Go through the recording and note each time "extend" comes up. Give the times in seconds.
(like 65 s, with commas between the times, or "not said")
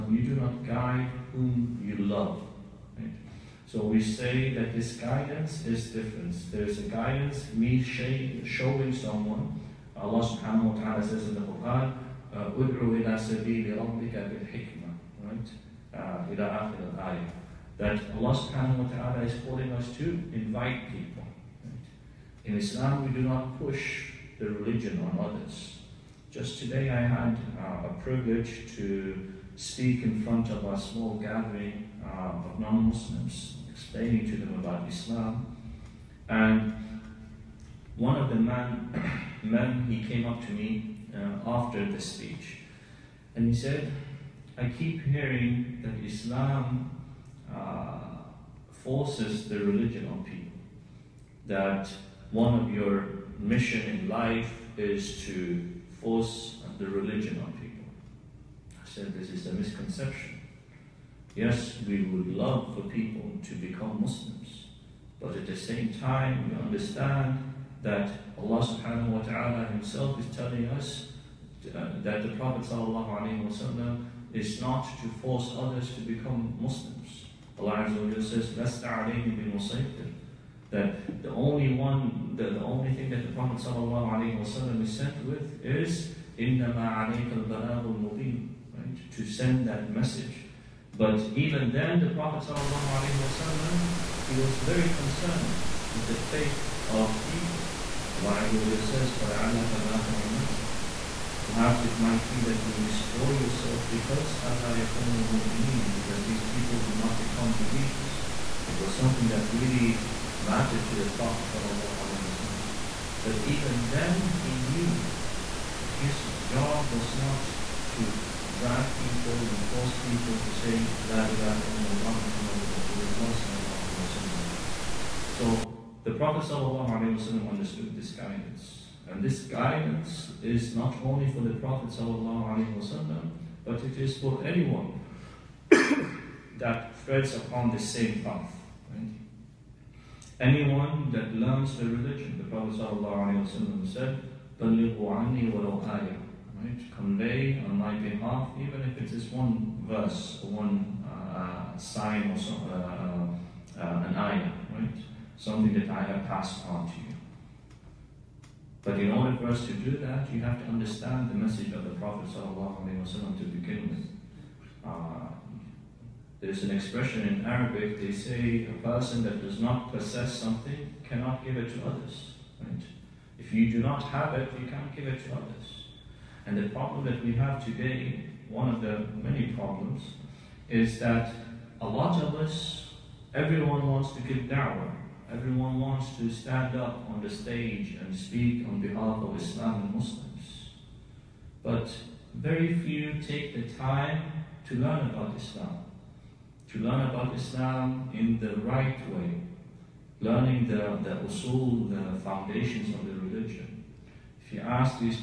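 not said.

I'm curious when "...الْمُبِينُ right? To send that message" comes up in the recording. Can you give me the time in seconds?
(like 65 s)
87 s.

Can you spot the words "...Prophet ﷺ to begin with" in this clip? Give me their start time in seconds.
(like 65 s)
161 s.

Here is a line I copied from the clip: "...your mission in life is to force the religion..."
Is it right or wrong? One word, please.
right.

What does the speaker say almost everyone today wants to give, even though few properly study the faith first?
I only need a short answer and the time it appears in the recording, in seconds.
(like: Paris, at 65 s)
Da'wah, at 184 s.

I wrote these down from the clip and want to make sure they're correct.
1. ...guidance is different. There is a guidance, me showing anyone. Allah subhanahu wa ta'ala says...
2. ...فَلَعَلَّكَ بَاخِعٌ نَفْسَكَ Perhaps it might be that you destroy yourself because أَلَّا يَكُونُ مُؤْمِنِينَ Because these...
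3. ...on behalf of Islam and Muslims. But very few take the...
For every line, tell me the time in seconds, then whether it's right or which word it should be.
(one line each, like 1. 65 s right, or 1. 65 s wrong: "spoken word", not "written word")
1. 4 s wrong: "someone", not "anyone"
2. 99 s right
3. 188 s right.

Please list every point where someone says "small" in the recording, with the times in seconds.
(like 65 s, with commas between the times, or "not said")
30 s.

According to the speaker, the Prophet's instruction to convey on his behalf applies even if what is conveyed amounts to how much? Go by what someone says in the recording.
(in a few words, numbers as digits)
One verse.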